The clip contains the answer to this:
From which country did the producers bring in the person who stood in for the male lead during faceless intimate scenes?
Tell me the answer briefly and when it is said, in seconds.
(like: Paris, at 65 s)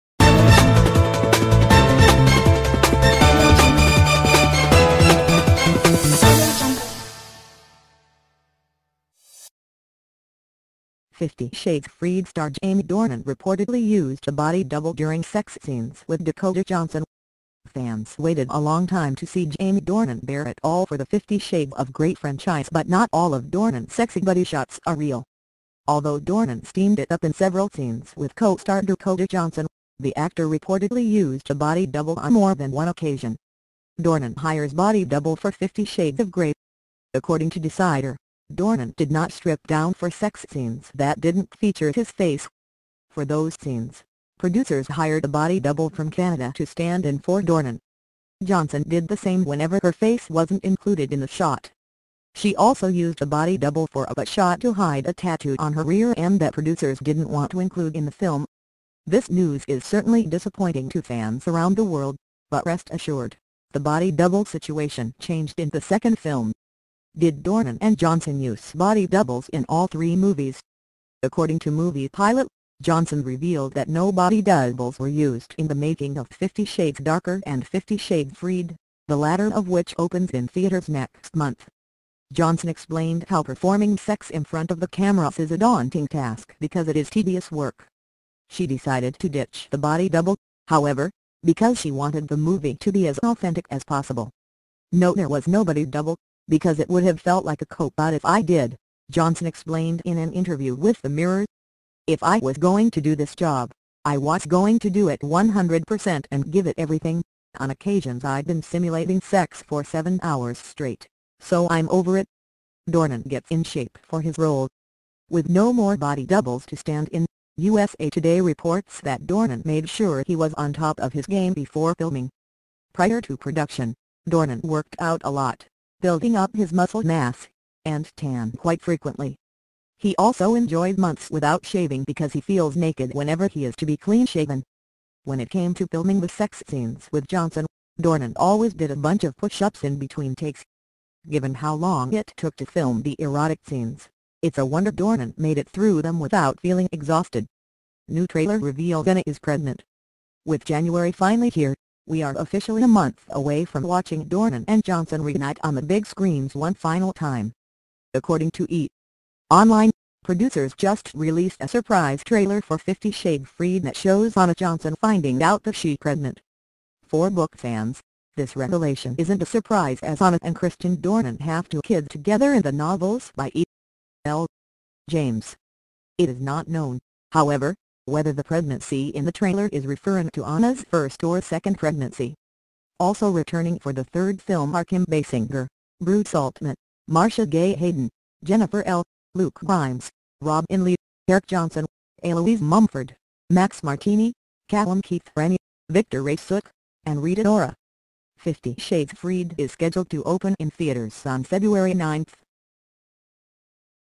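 Canada, at 46 s.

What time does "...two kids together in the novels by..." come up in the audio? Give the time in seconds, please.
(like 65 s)
171 s.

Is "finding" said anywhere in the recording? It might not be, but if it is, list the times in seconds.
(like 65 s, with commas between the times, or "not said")
164 s.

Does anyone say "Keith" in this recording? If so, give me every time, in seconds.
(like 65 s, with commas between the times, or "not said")
195 s.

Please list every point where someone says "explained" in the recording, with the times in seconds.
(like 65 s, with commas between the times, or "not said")
82 s, 99 s.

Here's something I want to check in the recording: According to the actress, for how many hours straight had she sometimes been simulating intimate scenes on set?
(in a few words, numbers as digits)
7.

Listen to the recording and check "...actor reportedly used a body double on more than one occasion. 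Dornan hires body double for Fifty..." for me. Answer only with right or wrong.
right.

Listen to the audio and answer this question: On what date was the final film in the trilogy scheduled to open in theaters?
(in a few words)
February 9th.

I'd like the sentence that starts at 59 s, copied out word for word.
This news is certainly disappointing to fans around the world, but rest assured, the body double situation changed in the second film.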